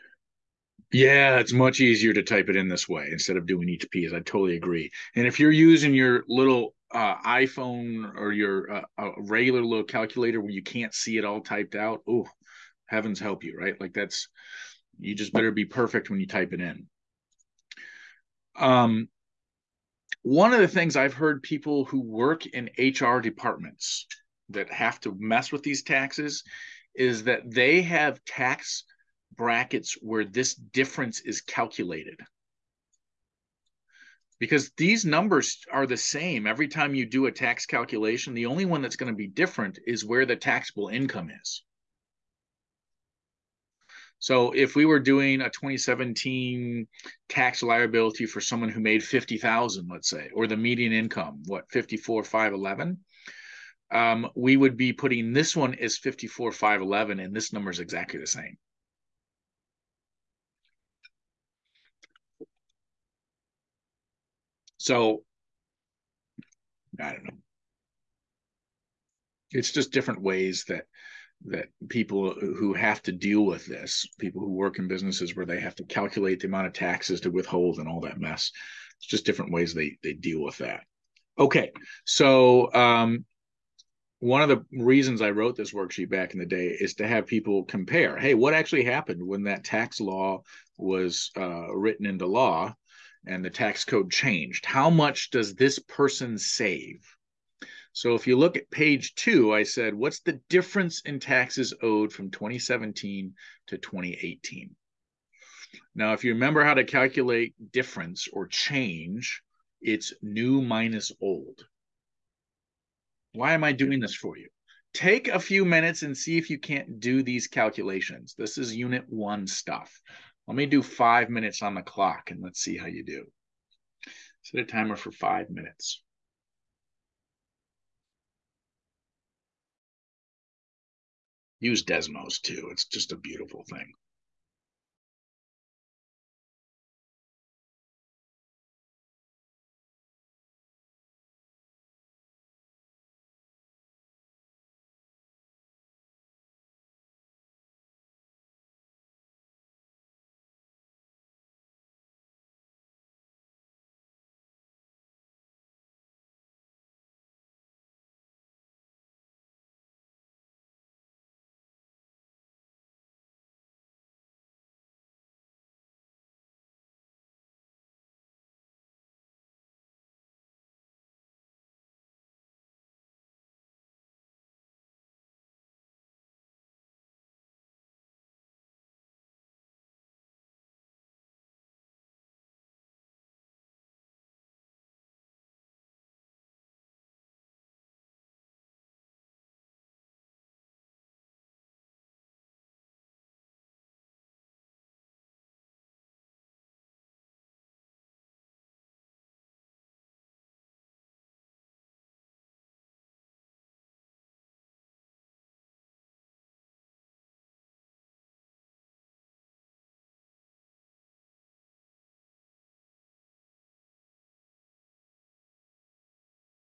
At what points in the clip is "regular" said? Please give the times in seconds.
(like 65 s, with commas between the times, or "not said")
9 s.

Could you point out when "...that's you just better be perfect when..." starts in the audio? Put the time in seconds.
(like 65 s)
13 s.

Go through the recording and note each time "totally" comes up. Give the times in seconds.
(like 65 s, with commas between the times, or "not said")
4 s.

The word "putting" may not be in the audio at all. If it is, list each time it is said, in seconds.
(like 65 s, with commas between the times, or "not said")
54 s.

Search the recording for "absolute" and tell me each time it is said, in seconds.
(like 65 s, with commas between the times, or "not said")
not said.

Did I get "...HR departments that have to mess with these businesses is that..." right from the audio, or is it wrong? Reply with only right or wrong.
wrong.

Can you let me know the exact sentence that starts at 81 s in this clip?
Okay, so um, one of the reasons I wrote this worksheet back in the day is to have people compare.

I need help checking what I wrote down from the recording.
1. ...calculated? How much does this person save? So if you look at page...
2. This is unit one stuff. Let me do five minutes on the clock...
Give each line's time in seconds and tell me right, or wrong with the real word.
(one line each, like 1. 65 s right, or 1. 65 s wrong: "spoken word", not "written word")
1. 94 s wrong: "changed", not "calculated"
2. 118 s right.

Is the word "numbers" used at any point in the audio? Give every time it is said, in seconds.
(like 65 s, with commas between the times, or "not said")
35 s, 57 s.